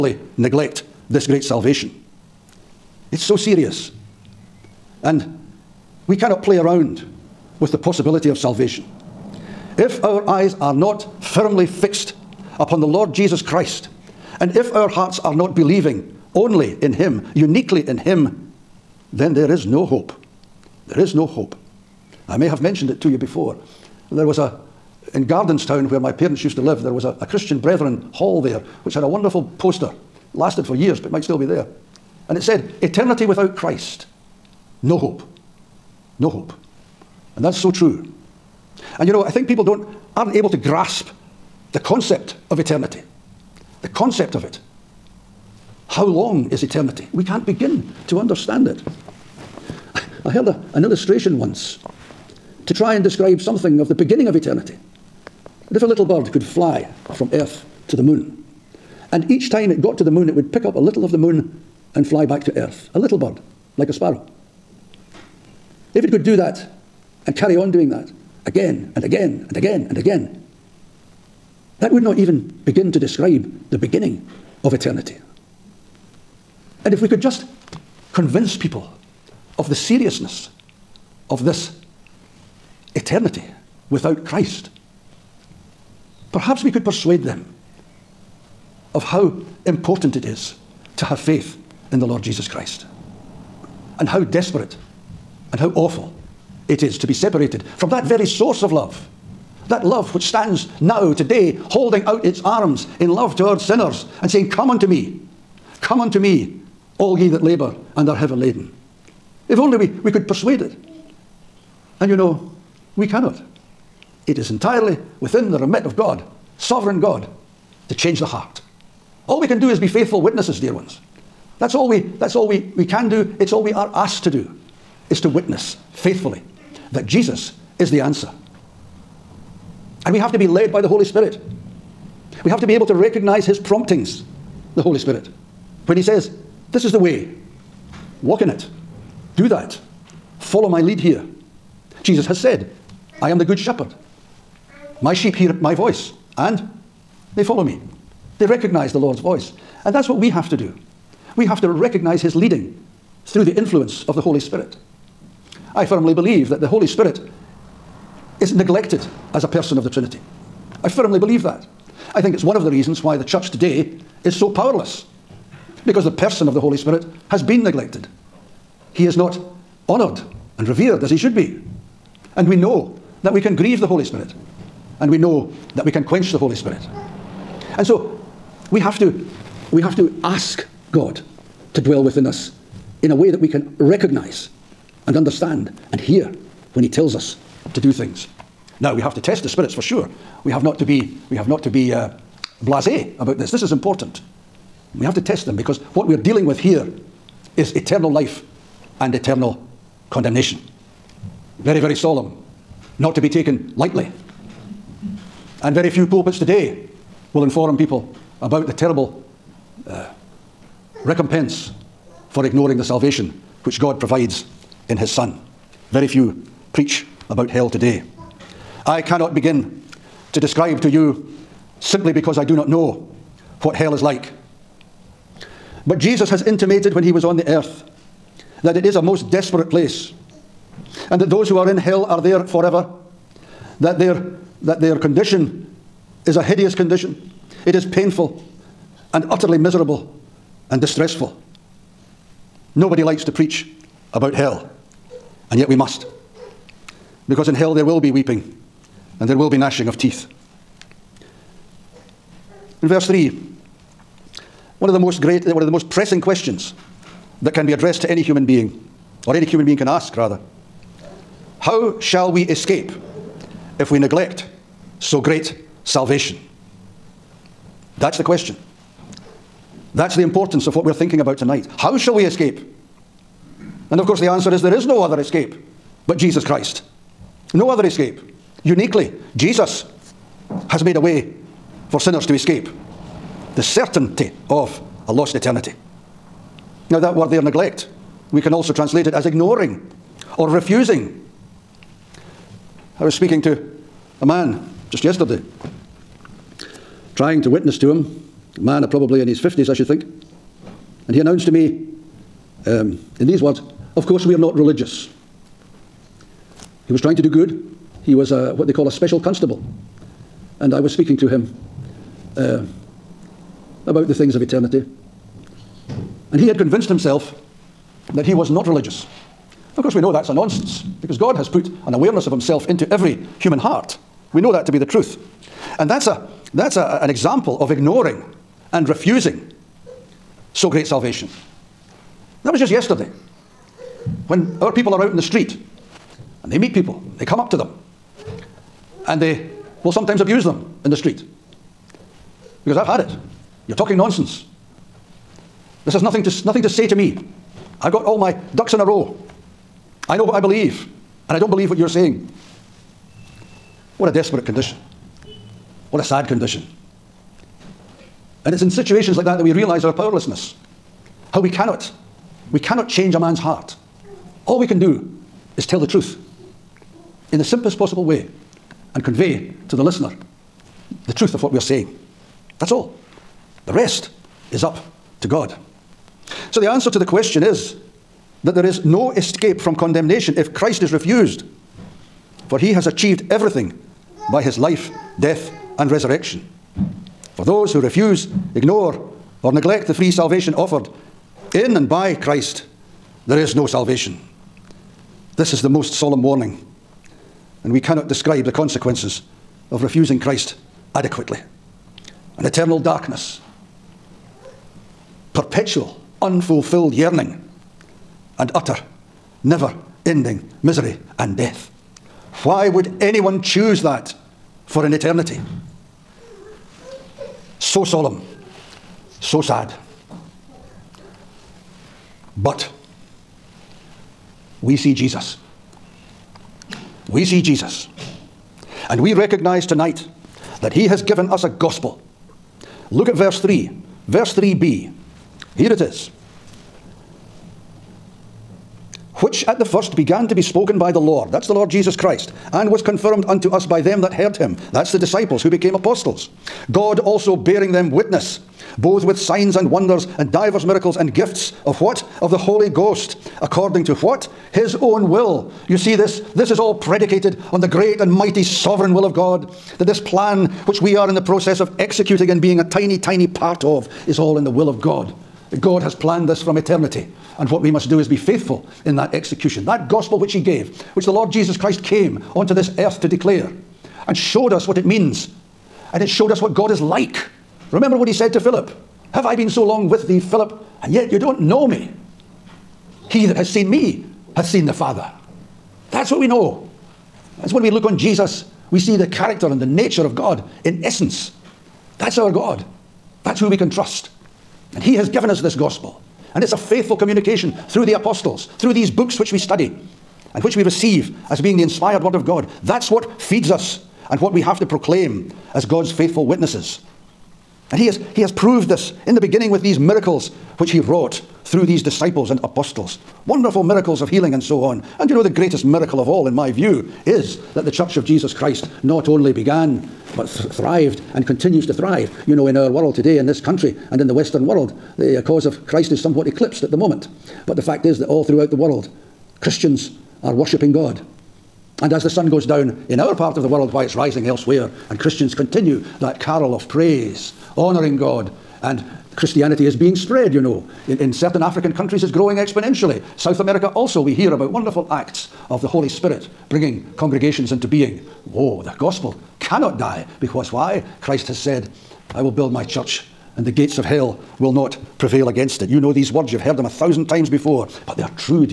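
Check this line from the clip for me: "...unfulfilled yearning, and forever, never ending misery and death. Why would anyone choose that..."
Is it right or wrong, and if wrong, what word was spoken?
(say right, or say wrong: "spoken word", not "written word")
wrong: "utter", not "forever".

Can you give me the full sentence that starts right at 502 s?
That's what feeds us and what we have to proclaim as God's faithful witnesses.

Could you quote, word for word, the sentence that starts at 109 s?
If only we, we could persuade it.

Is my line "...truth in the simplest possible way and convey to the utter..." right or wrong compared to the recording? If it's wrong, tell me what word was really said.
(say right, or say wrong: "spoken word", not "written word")
wrong: "listener", not "utter".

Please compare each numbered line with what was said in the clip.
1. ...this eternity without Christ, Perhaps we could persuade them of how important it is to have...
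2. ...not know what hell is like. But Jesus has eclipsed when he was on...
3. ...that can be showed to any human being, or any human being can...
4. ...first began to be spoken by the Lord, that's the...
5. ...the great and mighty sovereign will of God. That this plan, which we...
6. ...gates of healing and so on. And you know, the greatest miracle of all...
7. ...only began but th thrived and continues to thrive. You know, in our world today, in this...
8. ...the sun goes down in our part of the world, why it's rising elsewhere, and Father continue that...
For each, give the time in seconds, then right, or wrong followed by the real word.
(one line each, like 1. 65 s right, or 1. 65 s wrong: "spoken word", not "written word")
1. 81 s right
2. 222 s wrong: "intimated", not "eclipsed"
3. 257 s wrong: "addressed", not "showed"
4. 439 s right
5. 457 s right
6. 513 s wrong: "miracles", not "gates"
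7. 519 s right
8. 532 s wrong: "Christians", not "Father".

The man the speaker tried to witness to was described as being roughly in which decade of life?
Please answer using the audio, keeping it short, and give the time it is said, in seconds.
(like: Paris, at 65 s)
His 50s, at 299 s.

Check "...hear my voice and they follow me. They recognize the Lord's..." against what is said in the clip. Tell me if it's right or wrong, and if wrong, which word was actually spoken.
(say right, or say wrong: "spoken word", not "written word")
right.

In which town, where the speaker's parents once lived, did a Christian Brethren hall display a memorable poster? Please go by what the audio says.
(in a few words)
Gardenstown.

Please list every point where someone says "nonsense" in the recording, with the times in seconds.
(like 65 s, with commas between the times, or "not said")
320 s, 343 s.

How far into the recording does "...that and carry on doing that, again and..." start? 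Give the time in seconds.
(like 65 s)
66 s.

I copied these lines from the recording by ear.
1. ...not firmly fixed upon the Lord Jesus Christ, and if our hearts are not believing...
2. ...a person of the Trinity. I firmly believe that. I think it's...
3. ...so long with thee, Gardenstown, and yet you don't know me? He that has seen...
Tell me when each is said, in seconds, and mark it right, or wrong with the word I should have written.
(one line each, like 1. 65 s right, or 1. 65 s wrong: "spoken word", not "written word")
1. 10 s right
2. 159 s right
3. 479 s wrong: "Philip", not "Gardenstown".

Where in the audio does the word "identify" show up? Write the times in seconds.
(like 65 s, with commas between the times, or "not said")
not said.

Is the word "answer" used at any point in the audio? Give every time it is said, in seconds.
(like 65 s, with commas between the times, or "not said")
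128 s, 274 s, 376 s.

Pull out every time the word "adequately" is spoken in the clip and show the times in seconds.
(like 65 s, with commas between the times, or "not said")
400 s.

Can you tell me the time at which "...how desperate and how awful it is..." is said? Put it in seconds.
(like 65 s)
94 s.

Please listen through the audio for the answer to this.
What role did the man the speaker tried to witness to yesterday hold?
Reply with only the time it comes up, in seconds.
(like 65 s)
308 s.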